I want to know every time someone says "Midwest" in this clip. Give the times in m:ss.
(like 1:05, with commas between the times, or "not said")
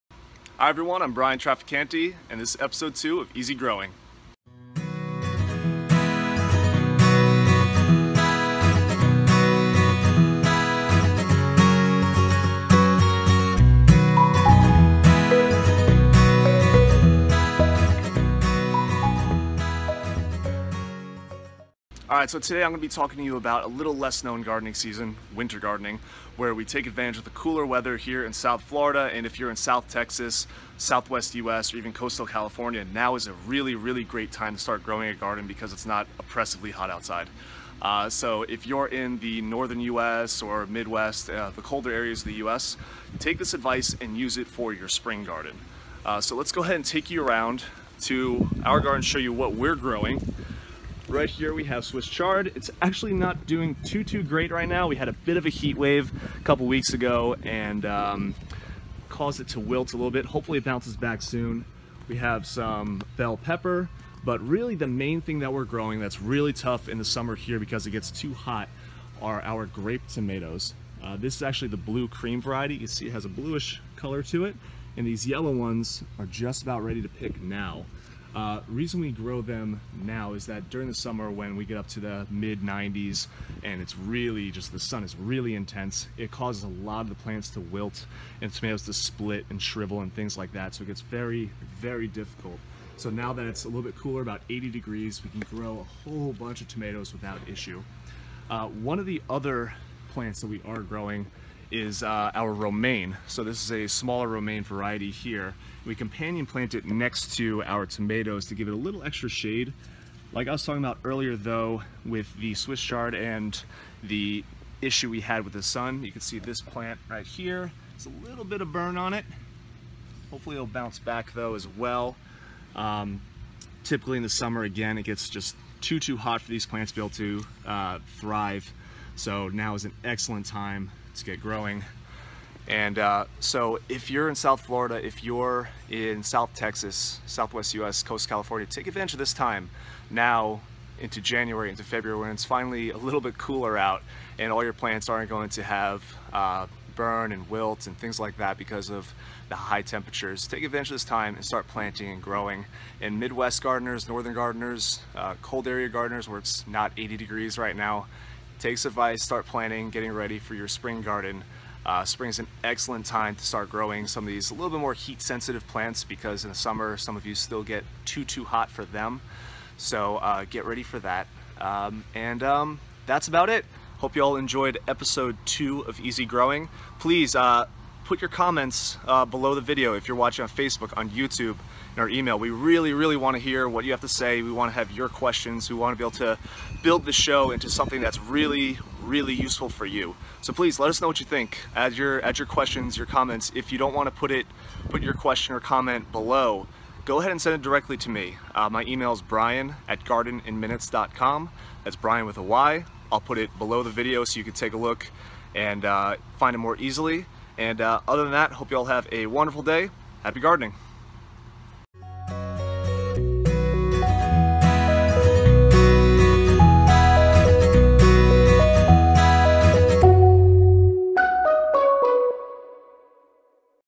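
0:40, 2:33.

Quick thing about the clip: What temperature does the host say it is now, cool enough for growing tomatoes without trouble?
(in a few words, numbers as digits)
80 degrees.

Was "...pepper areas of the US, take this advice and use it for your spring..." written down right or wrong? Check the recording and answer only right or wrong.
wrong.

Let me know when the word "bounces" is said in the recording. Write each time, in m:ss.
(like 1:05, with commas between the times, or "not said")
1:00, 2:00.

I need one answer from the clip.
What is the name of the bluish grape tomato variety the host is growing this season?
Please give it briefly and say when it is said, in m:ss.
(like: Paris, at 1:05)
Blue cream, at 1:11.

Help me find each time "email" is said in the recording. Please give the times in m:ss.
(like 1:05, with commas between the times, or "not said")
3:02, 3:18.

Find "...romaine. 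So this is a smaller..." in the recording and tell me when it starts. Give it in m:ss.
1:42.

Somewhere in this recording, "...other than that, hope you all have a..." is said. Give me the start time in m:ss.
3:28.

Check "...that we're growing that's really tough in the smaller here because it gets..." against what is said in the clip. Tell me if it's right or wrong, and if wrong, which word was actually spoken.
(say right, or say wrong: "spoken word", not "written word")
wrong: "summer", not "smaller".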